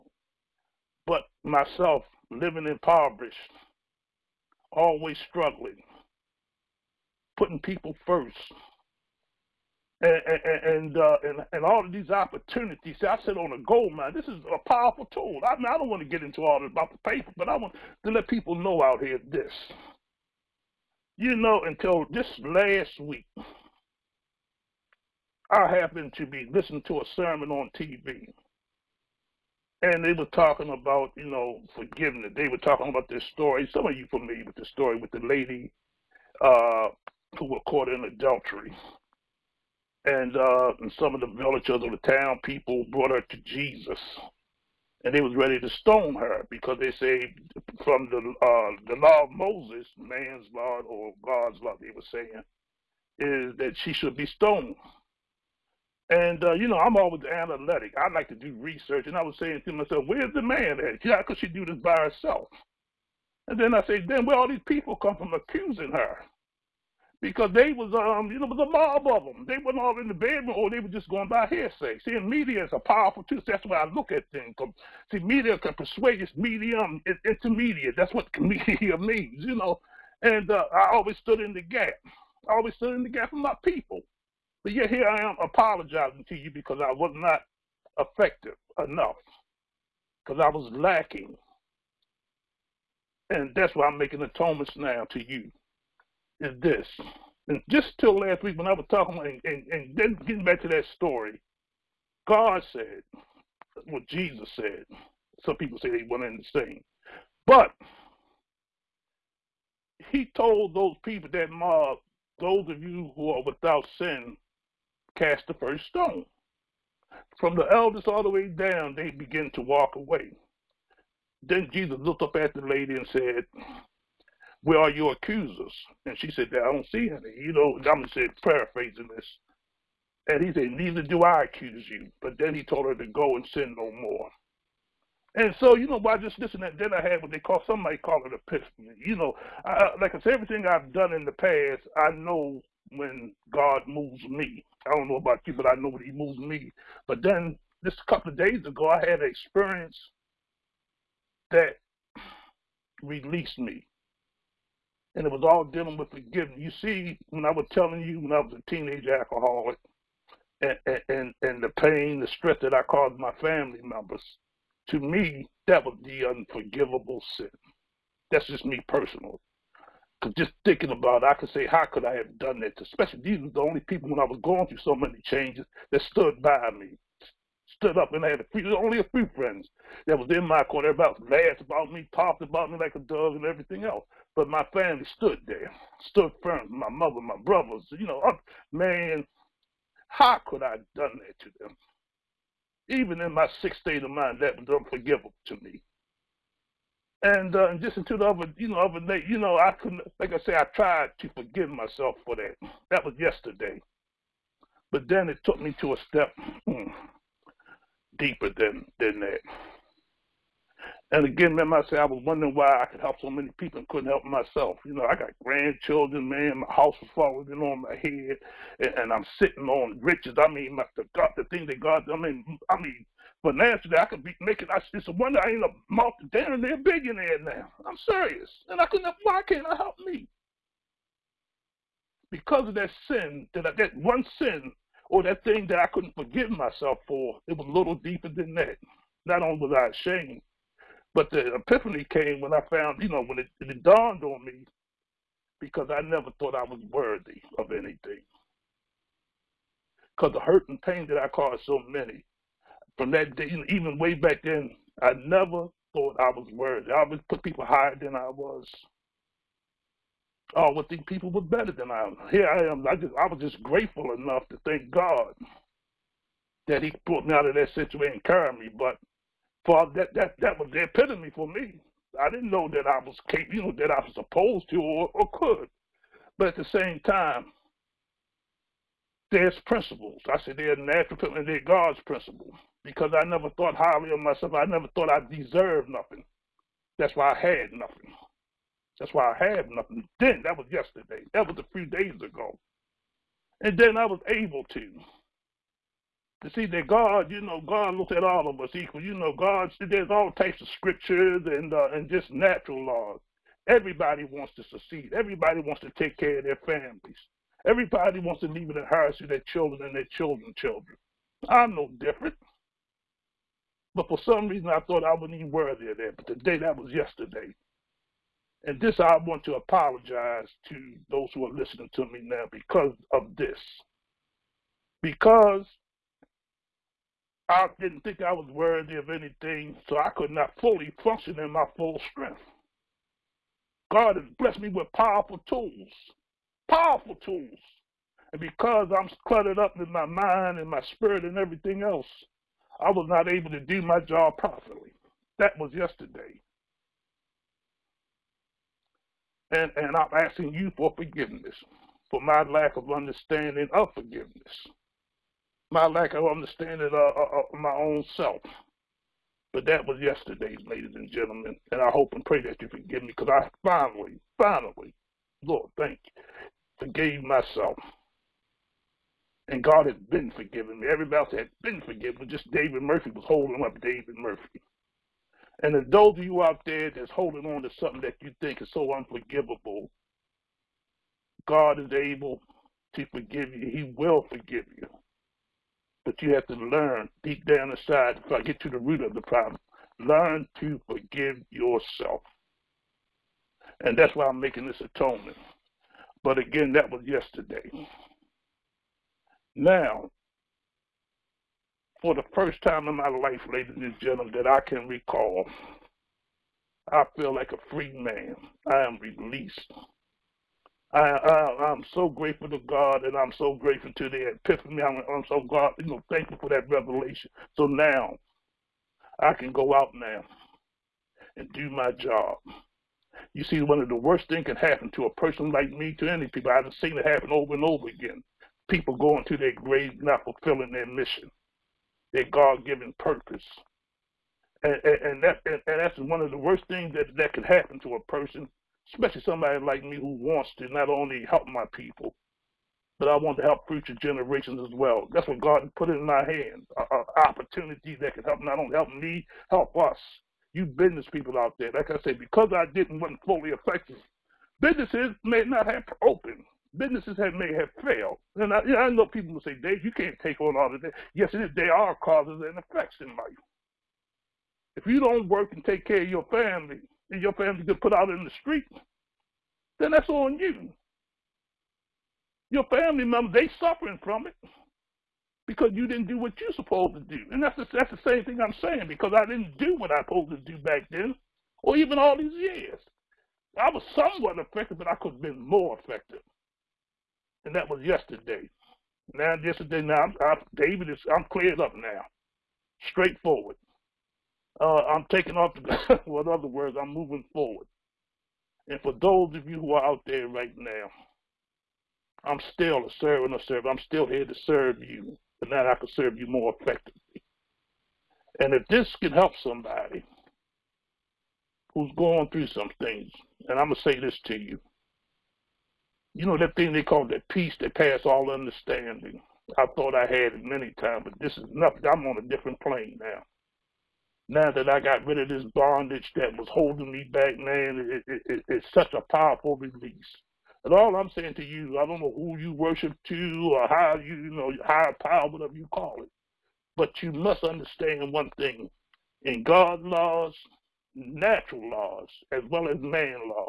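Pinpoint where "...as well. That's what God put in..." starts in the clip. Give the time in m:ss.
7:24.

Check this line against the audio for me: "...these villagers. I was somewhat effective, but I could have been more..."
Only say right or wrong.
wrong.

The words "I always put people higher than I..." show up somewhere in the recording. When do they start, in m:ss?
4:16.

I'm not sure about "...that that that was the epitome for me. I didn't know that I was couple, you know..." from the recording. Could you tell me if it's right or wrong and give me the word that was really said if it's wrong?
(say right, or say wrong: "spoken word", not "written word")
wrong: "capable", not "couple".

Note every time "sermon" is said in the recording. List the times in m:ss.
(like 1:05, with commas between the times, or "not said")
0:27.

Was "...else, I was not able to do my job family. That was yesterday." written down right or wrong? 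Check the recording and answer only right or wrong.
wrong.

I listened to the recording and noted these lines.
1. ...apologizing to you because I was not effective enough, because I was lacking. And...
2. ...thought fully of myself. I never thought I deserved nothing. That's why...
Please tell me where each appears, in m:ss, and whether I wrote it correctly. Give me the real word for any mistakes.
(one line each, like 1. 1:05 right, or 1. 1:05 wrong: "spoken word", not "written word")
1. 1:25 right
2. 4:43 wrong: "highly", not "fully".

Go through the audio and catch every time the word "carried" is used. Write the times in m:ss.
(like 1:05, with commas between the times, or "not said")
4:28.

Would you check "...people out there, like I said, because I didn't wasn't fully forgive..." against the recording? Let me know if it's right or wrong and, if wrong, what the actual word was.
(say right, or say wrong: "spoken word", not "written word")
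wrong: "effective", not "forgive".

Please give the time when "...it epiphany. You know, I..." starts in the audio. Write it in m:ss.
2:18.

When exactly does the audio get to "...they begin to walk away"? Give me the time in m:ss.
1:58.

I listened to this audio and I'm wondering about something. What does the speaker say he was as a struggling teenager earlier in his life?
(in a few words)
alcoholic.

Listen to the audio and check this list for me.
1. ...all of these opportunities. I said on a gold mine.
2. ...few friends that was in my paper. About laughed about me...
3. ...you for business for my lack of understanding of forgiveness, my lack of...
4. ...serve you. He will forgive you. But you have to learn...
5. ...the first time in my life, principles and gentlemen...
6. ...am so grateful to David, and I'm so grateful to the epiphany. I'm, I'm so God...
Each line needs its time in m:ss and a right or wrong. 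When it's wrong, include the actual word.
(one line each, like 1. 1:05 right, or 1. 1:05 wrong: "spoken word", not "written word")
1. 0:11 right
2. 2:59 wrong: "corner", not "paper"
3. 5:50 wrong: "forgiveness", not "business"
4. 6:23 wrong: "forgive", not "serve"
5. 6:42 wrong: "ladies", not "principles"
6. 6:51 wrong: "God", not "David".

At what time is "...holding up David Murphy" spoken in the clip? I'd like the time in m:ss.
6:13.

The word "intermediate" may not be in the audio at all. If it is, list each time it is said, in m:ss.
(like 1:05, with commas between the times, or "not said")
1:17.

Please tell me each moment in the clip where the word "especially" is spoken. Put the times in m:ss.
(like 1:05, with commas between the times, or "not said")
2:52, 7:18.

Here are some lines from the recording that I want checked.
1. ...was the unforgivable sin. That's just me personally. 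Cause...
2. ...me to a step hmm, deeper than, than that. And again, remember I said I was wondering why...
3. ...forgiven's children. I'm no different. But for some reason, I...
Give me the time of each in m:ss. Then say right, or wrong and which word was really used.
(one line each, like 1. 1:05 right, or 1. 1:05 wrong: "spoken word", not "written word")
1. 2:45 right
2. 3:25 right
3. 5:10 wrong: "children", not "forgiven".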